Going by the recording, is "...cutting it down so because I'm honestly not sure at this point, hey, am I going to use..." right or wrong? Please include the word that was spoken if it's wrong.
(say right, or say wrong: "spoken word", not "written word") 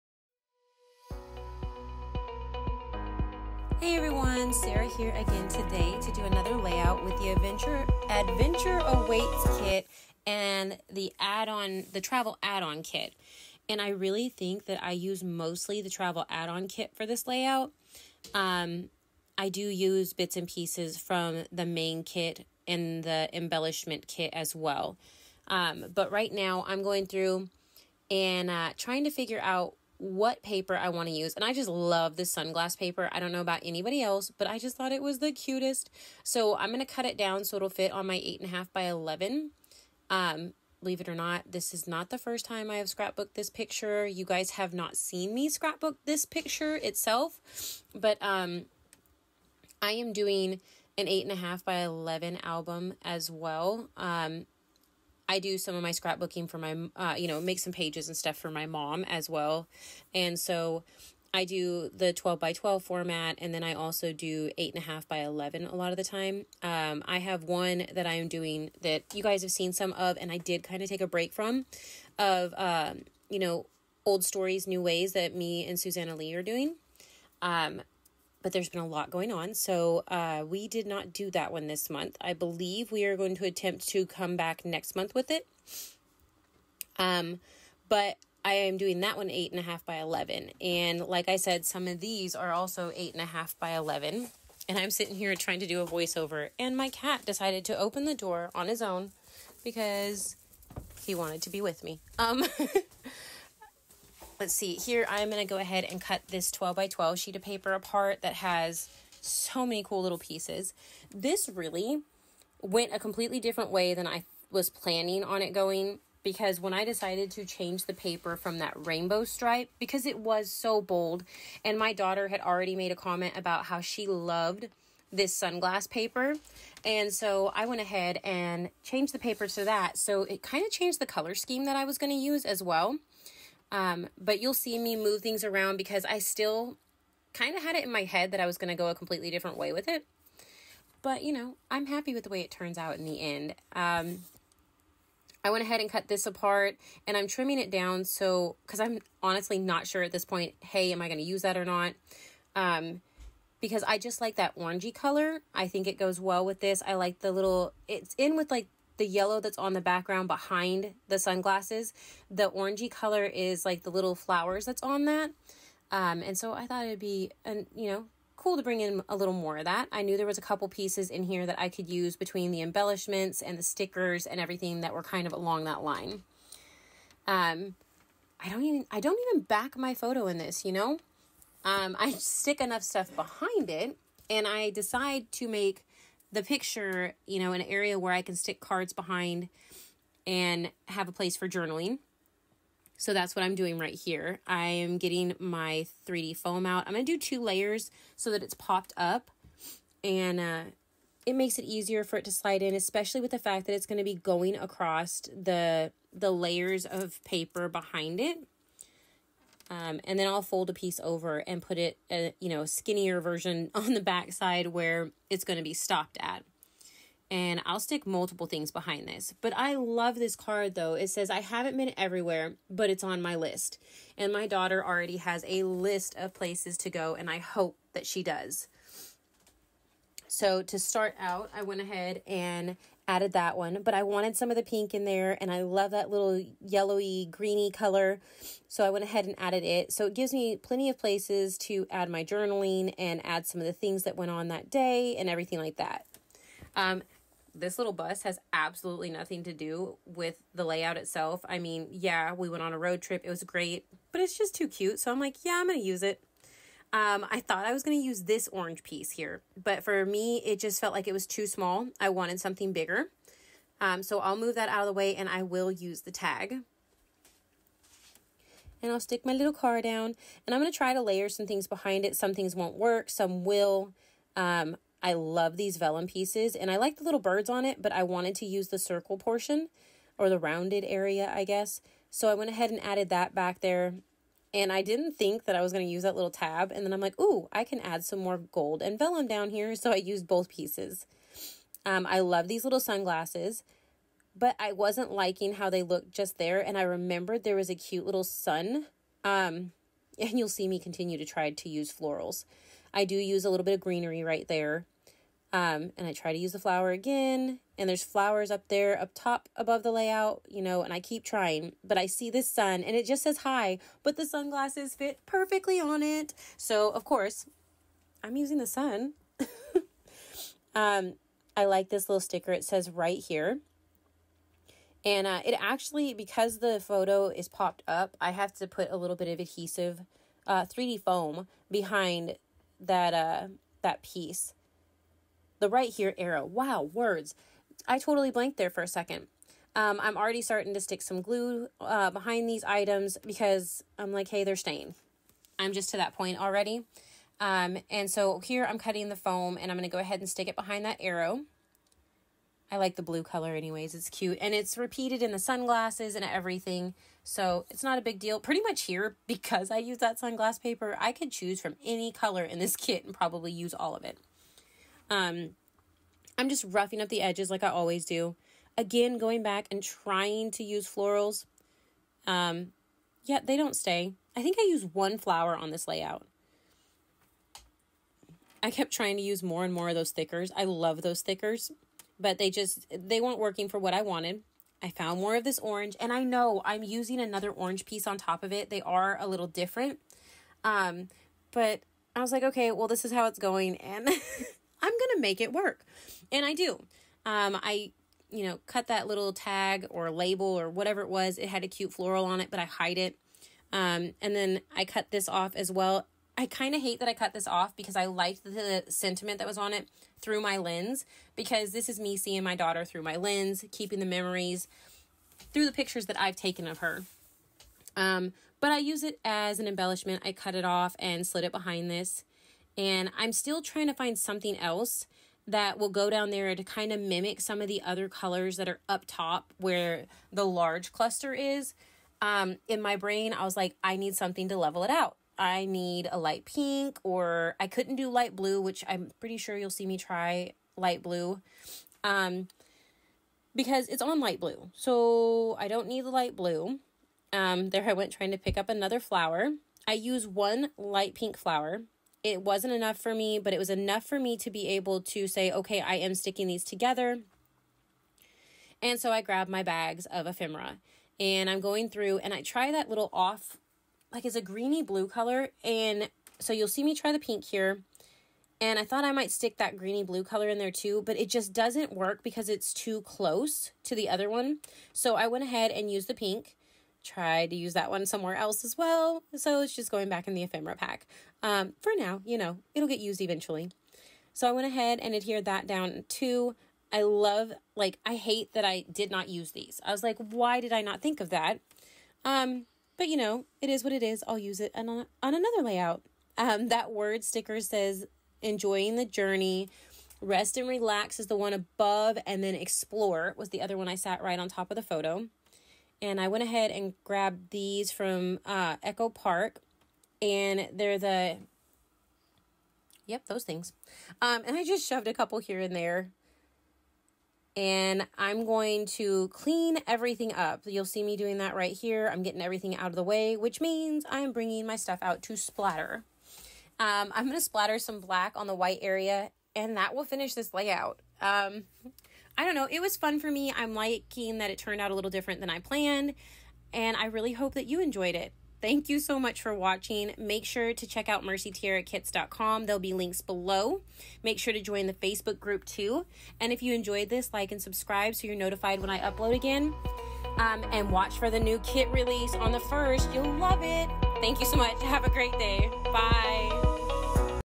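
wrong: "trimming", not "cutting".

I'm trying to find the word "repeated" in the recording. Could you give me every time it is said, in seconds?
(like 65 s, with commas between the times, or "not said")
354 s.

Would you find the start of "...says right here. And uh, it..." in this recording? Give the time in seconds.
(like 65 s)
322 s.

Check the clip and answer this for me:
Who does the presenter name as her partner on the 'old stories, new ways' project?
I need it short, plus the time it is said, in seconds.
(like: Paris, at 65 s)
Susanna Lee, at 75 s.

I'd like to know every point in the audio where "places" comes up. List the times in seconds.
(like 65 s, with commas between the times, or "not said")
191 s, 226 s, 240 s.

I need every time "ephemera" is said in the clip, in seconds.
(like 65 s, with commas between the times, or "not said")
460 s, 480 s.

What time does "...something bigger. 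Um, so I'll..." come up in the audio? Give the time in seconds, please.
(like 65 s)
262 s.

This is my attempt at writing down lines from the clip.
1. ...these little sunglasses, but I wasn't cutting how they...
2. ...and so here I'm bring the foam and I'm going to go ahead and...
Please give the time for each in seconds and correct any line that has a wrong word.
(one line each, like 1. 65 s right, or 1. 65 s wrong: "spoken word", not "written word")
1. 292 s wrong: "liking", not "cutting"
2. 347 s wrong: "cutting", not "bring".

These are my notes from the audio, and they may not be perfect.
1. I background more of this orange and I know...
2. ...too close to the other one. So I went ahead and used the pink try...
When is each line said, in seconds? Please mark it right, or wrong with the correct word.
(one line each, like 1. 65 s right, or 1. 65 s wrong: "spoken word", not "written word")
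1. 384 s wrong: "found", not "background"
2. 472 s right.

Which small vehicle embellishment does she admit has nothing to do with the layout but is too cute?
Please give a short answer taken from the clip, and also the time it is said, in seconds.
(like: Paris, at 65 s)
bus, at 247 s.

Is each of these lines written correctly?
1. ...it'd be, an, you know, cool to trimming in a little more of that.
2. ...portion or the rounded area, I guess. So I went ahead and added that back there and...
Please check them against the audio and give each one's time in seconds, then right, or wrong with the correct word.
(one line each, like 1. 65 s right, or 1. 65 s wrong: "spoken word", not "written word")
1. 166 s wrong: "bring", not "trimming"
2. 279 s right.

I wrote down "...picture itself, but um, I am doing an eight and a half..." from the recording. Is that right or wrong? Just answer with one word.
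right.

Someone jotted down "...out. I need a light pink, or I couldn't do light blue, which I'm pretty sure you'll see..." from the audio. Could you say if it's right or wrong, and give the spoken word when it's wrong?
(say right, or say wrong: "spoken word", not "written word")
right.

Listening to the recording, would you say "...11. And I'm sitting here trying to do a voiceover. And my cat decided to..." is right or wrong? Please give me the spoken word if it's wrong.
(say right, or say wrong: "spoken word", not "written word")
right.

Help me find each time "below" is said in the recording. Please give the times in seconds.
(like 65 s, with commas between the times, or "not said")
543 s.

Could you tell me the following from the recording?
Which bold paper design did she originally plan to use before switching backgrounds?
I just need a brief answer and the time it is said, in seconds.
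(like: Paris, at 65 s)
rainbow stripe, at 118 s.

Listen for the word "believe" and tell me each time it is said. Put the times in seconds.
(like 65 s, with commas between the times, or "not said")
40 s, 82 s.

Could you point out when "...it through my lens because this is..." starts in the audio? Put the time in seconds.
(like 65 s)
409 s.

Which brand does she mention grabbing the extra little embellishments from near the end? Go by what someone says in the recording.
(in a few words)
Echo Park.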